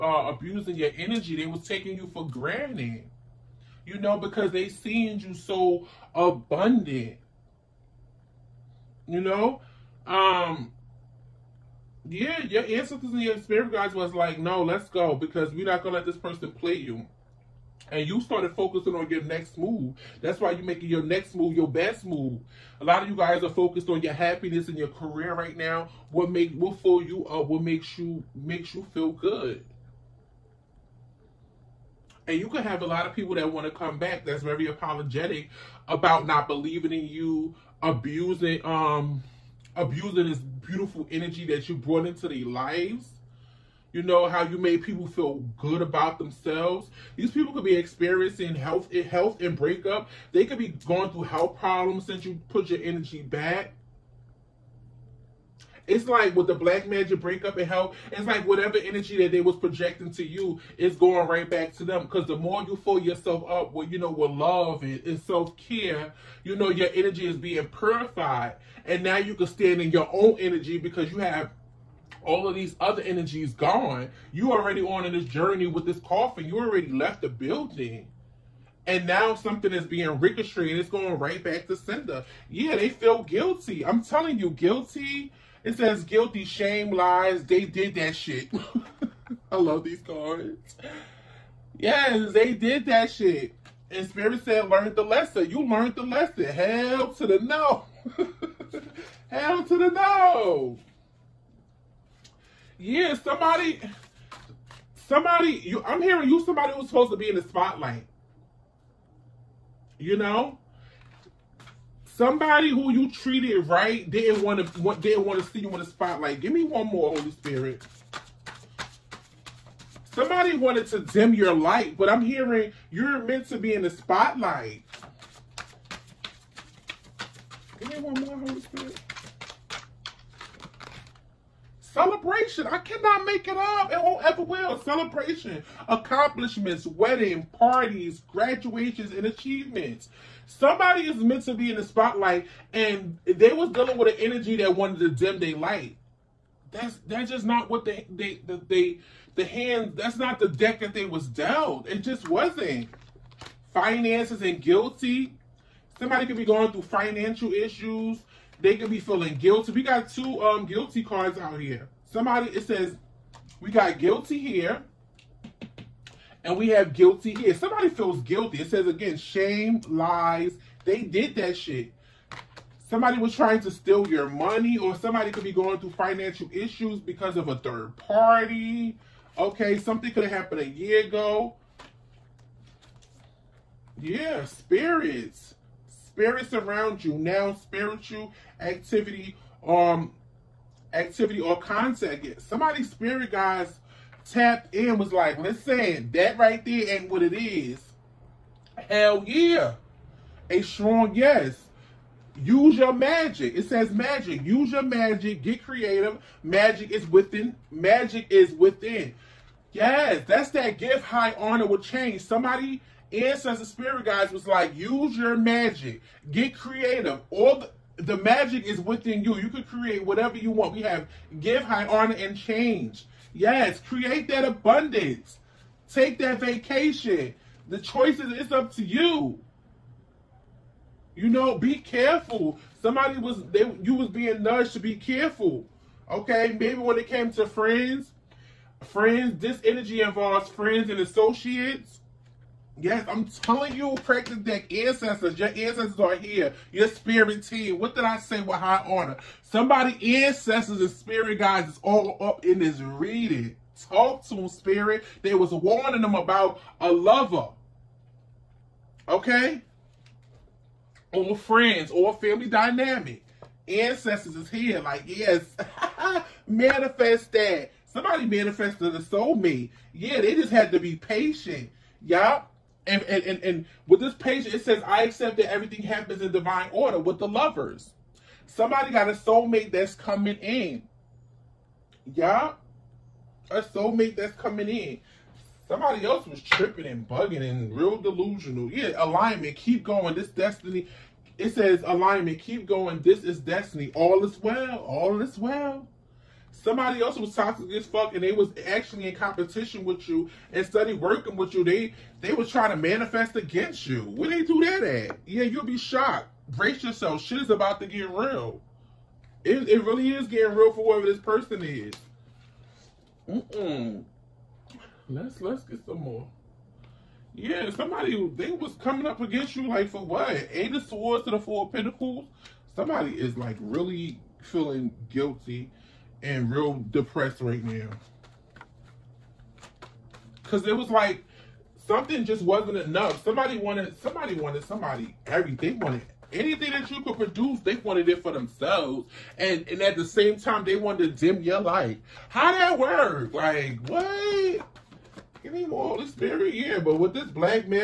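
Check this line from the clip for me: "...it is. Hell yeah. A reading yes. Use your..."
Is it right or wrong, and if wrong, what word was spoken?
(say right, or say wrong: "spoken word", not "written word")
wrong: "strong", not "reading".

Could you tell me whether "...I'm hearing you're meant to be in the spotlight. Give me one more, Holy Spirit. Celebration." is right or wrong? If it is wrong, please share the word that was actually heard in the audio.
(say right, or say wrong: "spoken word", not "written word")
right.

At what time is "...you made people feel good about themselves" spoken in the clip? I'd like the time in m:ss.
0:44.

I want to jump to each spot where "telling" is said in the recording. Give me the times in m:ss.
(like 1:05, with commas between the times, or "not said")
1:24, 4:03.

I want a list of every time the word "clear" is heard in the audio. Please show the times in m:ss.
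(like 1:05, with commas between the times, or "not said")
not said.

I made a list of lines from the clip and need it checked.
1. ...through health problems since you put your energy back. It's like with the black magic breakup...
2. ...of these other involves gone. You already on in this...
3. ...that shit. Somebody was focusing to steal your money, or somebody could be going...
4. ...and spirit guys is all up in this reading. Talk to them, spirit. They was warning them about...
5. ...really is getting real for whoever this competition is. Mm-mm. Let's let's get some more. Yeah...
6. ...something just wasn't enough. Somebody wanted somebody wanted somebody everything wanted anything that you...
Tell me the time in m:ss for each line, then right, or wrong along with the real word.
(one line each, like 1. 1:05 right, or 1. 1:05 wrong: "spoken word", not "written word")
1. 0:51 right
2. 1:12 wrong: "energies", not "involves"
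3. 2:51 wrong: "trying", not "focusing"
4. 4:10 right
5. 5:09 wrong: "person", not "competition"
6. 5:31 right.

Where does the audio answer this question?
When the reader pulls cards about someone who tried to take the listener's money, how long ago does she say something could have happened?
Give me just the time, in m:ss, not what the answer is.
3:00.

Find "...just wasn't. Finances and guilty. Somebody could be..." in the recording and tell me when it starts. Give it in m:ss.
2:31.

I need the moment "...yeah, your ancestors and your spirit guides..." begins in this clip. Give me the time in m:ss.
0:12.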